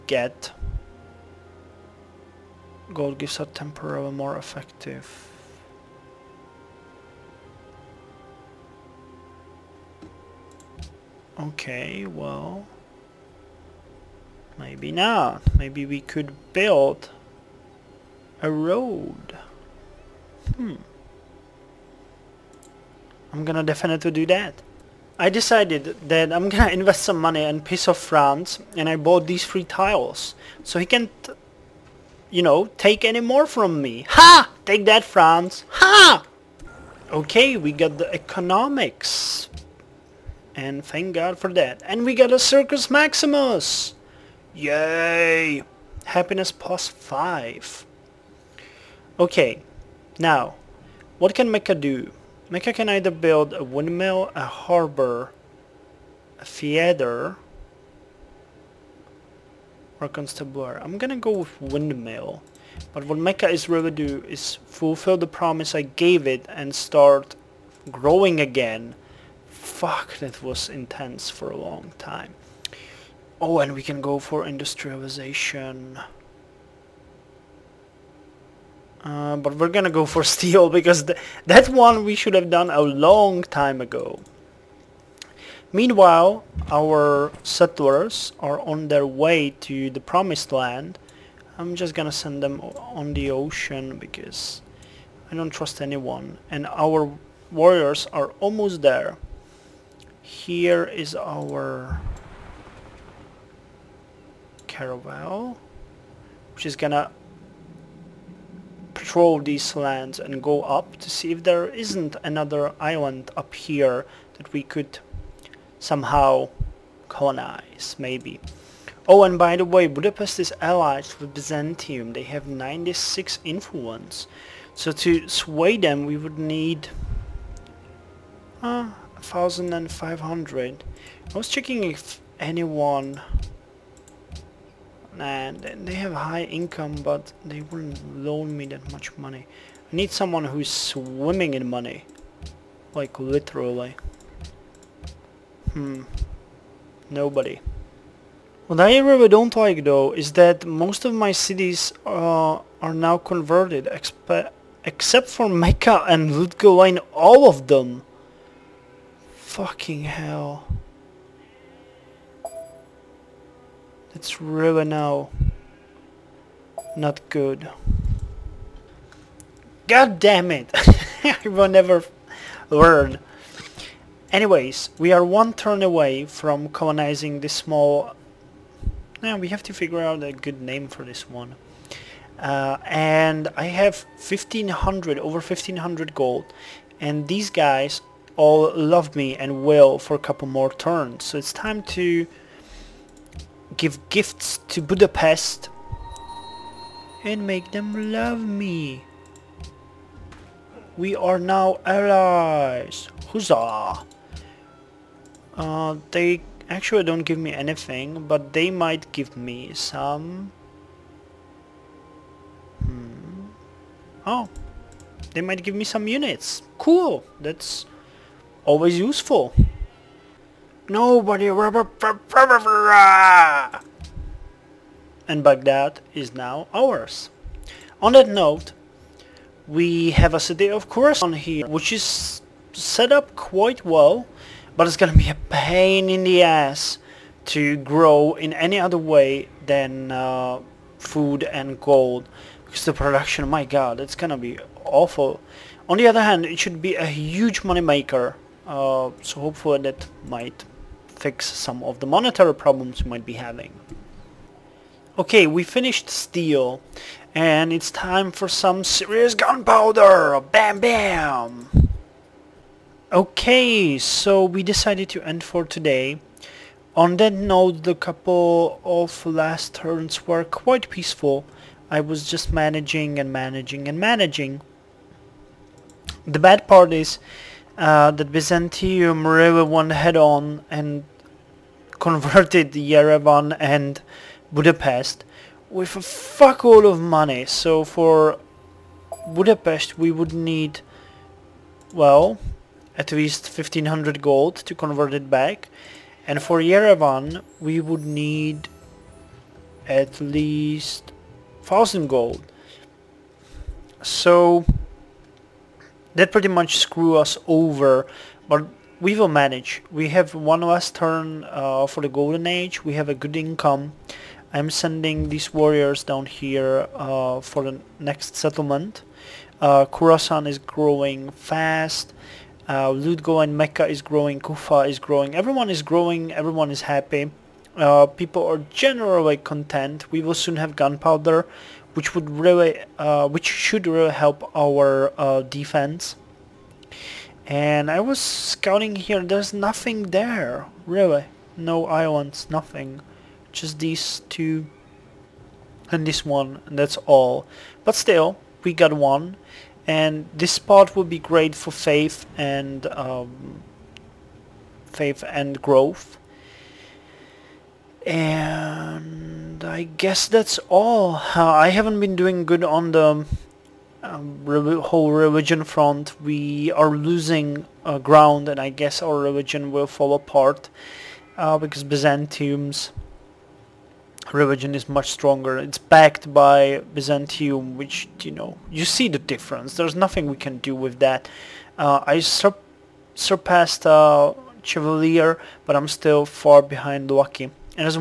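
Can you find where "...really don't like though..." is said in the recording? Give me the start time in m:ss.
2:28.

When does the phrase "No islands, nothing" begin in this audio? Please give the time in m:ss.
5:41.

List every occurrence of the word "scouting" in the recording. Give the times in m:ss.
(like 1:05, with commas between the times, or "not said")
5:38.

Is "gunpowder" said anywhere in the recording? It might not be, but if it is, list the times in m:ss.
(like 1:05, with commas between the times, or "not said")
4:19, 5:30.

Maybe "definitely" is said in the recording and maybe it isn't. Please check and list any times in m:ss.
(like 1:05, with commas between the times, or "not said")
0:23.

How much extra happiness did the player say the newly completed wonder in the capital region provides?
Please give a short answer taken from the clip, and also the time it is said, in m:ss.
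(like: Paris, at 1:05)
5, at 0:46.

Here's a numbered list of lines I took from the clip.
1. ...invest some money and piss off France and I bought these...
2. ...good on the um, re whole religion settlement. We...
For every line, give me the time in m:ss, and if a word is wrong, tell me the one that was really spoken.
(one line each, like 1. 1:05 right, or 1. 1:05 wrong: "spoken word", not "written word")
1. 0:26 right
2. 6:02 wrong: "front", not "settlement".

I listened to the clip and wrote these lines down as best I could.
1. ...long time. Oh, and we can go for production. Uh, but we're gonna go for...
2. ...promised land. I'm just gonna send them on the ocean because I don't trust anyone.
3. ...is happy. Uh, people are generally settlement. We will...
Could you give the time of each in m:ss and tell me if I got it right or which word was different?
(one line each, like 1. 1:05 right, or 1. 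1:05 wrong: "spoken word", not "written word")
1. 1:11 wrong: "industrialization", not "production"
2. 1:29 right
3. 5:26 wrong: "content", not "settlement".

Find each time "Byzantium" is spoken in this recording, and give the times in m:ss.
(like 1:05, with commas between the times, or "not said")
2:01, 4:38, 6:11, 6:16.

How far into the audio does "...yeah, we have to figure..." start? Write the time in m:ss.
2:59.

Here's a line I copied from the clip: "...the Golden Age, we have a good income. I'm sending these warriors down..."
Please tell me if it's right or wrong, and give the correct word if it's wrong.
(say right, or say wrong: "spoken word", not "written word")
right.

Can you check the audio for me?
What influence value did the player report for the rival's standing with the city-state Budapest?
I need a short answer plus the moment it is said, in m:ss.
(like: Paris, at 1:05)
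96, at 2:02.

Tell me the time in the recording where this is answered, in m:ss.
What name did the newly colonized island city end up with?
3:45.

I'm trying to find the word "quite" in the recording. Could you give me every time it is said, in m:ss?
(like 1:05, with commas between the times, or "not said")
3:53, 4:30.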